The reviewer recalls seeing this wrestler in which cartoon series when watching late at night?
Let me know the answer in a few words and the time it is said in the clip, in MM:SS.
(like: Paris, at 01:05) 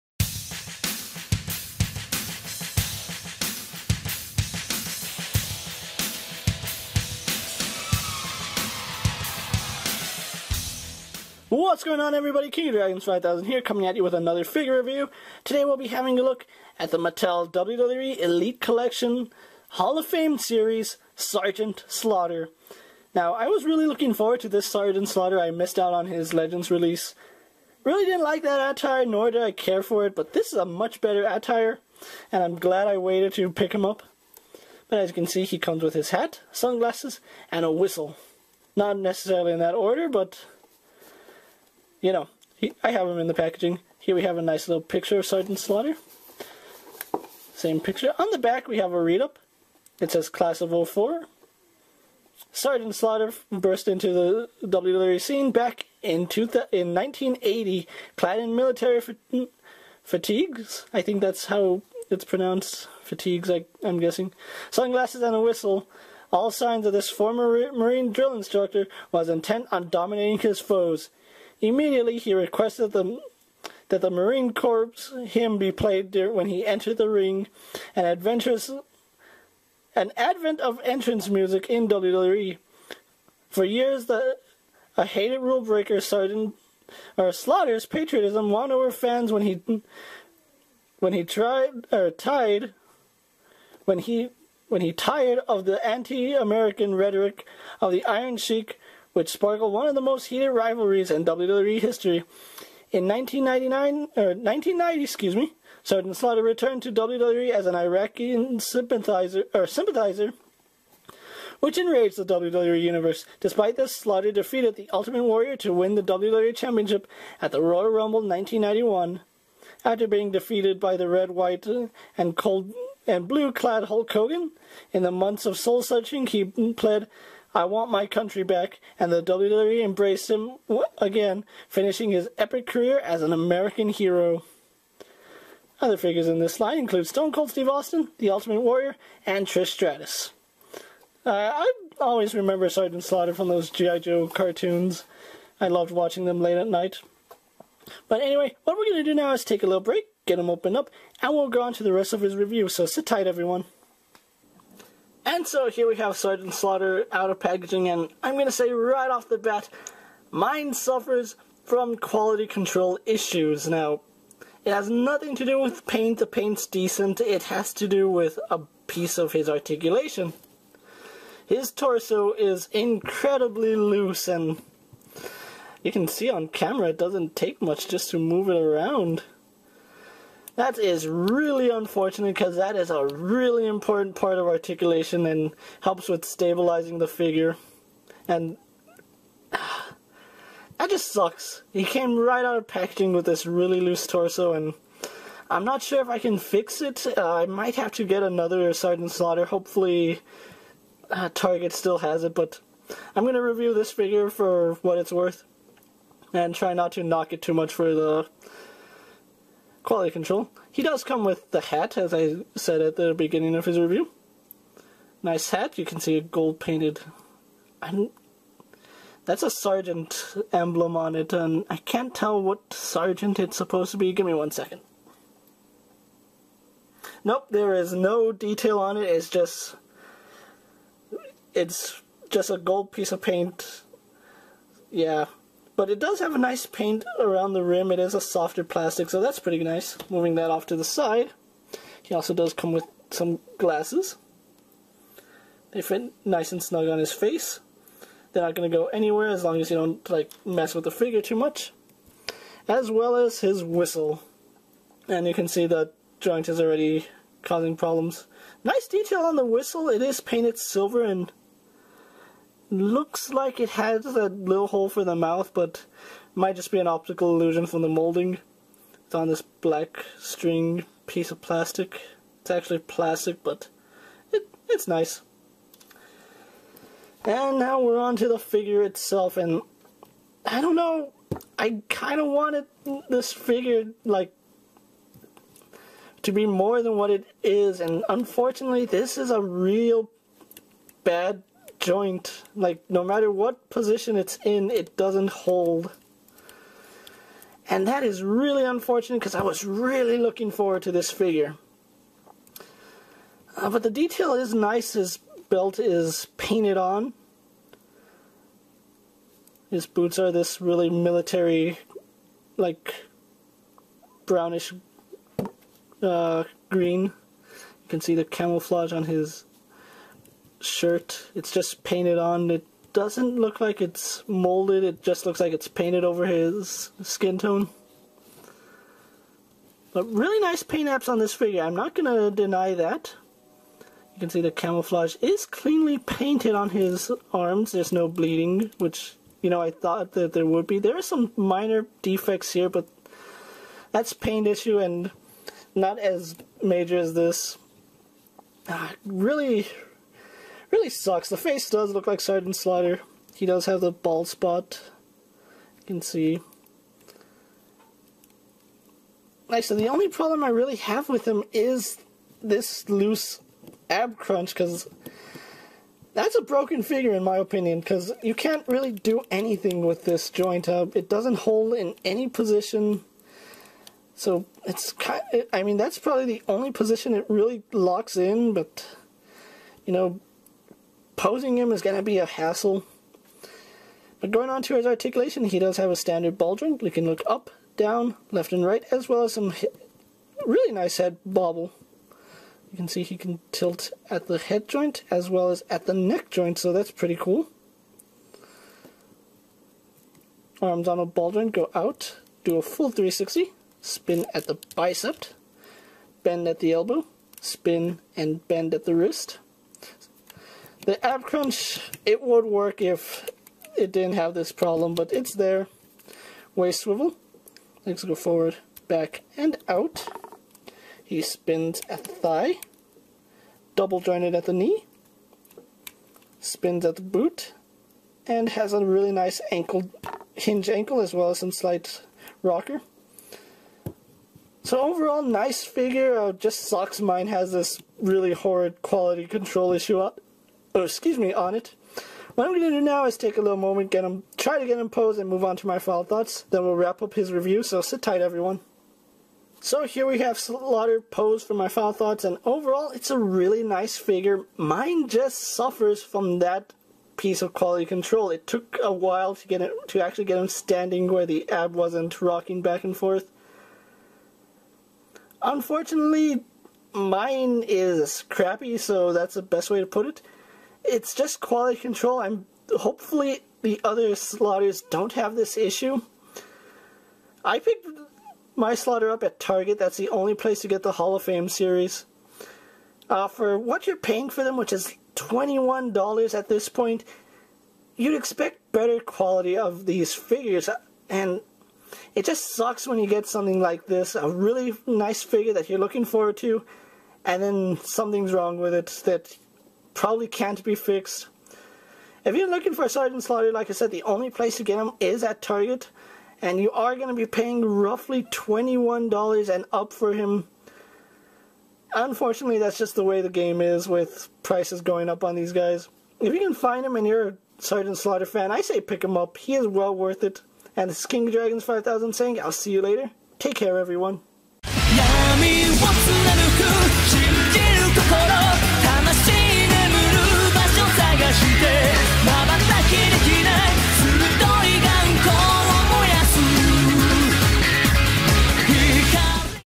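G.I. Joe, at 02:23.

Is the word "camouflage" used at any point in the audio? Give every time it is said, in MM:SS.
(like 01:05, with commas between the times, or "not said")
05:18, 05:34.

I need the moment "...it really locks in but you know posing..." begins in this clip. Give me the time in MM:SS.
06:17.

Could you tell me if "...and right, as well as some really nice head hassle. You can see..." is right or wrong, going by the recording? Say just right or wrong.
wrong.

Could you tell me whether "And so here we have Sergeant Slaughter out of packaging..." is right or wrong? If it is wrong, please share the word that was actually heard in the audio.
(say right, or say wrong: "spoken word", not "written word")
right.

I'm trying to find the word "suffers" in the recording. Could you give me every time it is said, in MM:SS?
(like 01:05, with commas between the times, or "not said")
02:40, 07:35.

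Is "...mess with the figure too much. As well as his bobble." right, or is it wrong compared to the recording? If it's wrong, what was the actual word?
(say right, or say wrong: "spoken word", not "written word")
wrong: "whistle", not "bobble".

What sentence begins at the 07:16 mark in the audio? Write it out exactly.
Uh, just sucks mine has this really horrid quality control issue oh, excuse me, on it.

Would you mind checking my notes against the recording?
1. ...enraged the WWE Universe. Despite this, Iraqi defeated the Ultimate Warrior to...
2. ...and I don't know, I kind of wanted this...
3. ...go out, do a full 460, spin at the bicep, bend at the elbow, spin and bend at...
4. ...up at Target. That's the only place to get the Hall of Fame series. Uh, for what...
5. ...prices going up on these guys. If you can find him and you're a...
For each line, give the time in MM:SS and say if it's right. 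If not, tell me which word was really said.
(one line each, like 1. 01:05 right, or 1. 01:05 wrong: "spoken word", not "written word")
1. 01:51 wrong: "Slaughter", not "Iraqi"
2. 04:39 right
3. 06:41 wrong: "360", not "460"
4. 07:59 right
5. 08:34 right.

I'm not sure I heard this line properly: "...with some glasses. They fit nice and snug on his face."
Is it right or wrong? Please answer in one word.
right.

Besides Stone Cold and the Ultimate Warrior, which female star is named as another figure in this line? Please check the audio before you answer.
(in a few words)
Trish Stratus.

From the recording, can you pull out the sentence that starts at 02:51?
His torso is incredibly loose, and you can see on camera it doesn't take much just to move it around.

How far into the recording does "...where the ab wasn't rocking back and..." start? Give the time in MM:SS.
07:41.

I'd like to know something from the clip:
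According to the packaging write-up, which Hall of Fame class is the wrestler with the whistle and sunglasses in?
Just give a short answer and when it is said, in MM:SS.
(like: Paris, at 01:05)
Class of 04, at 00:50.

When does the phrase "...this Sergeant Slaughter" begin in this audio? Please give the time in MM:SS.
00:24.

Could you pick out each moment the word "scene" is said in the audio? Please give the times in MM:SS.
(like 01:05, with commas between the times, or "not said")
00:55.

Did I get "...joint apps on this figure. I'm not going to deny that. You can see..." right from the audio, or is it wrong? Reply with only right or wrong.
wrong.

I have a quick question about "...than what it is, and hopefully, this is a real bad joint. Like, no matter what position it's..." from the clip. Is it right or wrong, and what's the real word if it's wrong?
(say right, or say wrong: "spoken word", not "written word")
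wrong: "unfortunately", not "hopefully".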